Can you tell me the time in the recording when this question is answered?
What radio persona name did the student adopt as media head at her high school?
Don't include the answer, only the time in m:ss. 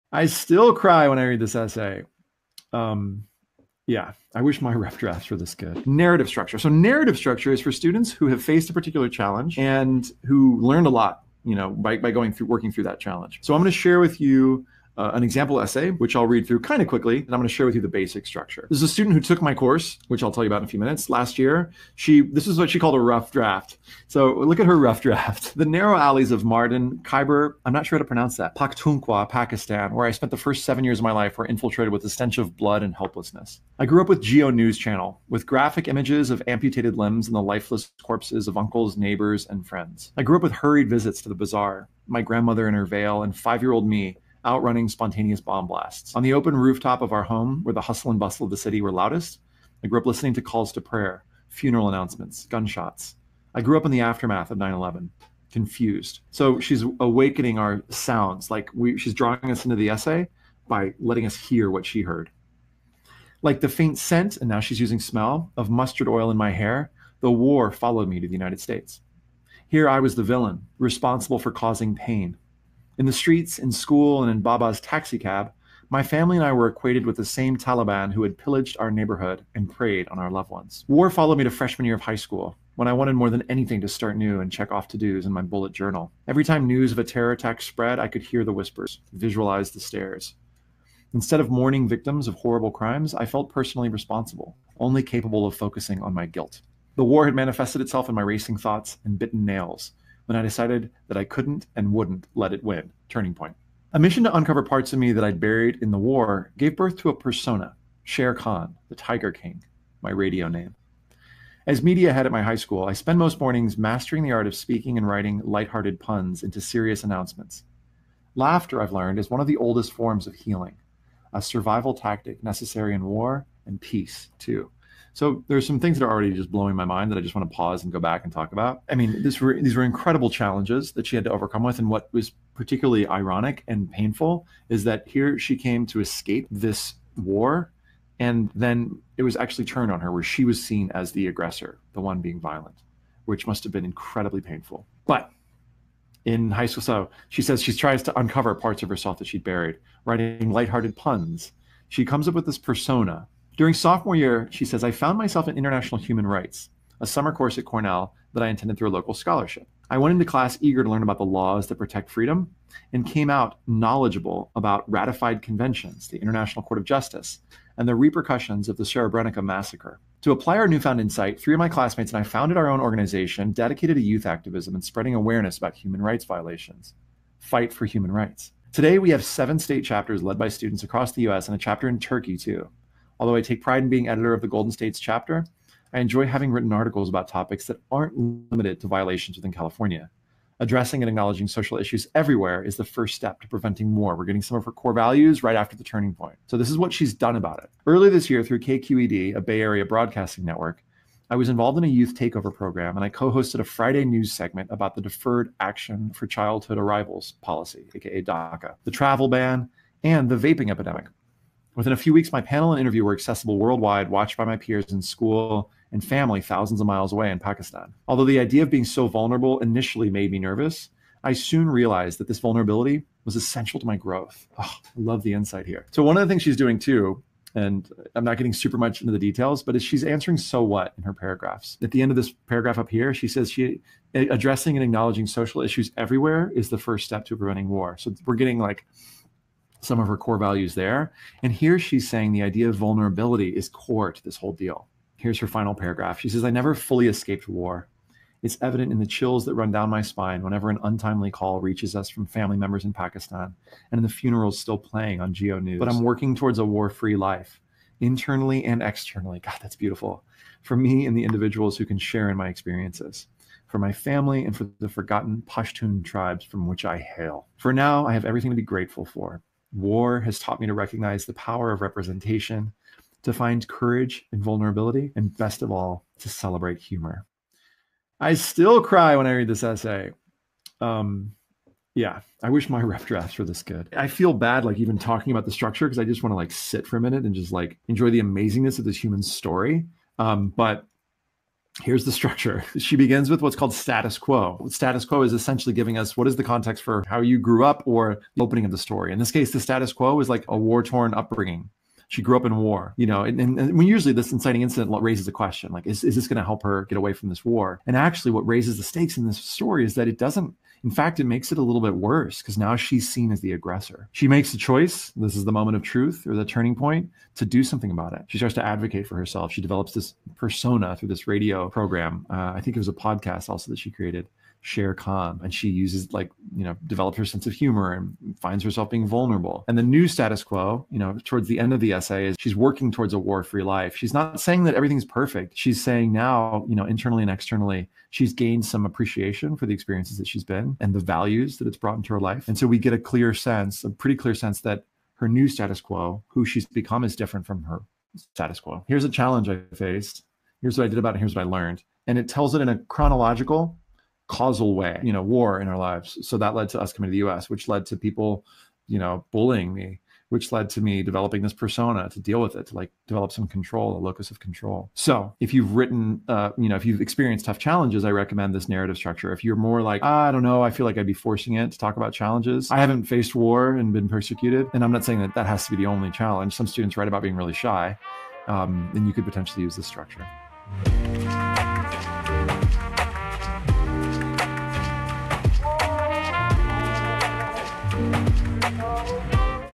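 1:48.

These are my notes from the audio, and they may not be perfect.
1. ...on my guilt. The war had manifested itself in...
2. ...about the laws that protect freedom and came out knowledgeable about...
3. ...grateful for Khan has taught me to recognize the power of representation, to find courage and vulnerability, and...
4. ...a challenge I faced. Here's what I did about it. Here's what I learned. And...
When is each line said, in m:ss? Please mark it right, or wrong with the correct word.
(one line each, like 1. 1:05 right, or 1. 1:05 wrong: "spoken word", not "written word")
1. 1:36 right
2. 2:41 right
3. 4:28 wrong: "War", not "Khan"
4. 5:49 right.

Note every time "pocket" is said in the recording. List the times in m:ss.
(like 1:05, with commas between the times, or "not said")
not said.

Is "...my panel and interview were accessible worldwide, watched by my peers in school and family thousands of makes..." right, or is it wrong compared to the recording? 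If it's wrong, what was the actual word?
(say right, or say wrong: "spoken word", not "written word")
wrong: "miles", not "makes".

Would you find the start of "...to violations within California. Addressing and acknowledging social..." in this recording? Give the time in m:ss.
3:08.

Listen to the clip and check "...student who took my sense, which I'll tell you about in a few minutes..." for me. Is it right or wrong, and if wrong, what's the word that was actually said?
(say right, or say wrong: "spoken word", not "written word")
wrong: "course", not "sense".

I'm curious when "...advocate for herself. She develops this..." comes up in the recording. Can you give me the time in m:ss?
5:18.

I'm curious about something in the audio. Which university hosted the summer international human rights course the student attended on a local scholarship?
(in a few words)
Cornell.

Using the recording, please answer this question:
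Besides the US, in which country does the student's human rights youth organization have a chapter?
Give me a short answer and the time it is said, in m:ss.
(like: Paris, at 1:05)
Turkey, at 3:01.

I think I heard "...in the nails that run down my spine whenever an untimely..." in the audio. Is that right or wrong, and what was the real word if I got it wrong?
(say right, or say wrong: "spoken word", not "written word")
wrong: "chills", not "nails".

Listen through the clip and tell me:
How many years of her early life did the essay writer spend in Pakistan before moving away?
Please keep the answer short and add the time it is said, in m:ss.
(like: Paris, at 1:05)
7, at 0:30.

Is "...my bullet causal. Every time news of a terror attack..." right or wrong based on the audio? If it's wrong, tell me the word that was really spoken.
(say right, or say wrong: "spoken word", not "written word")
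wrong: "journal", not "causal".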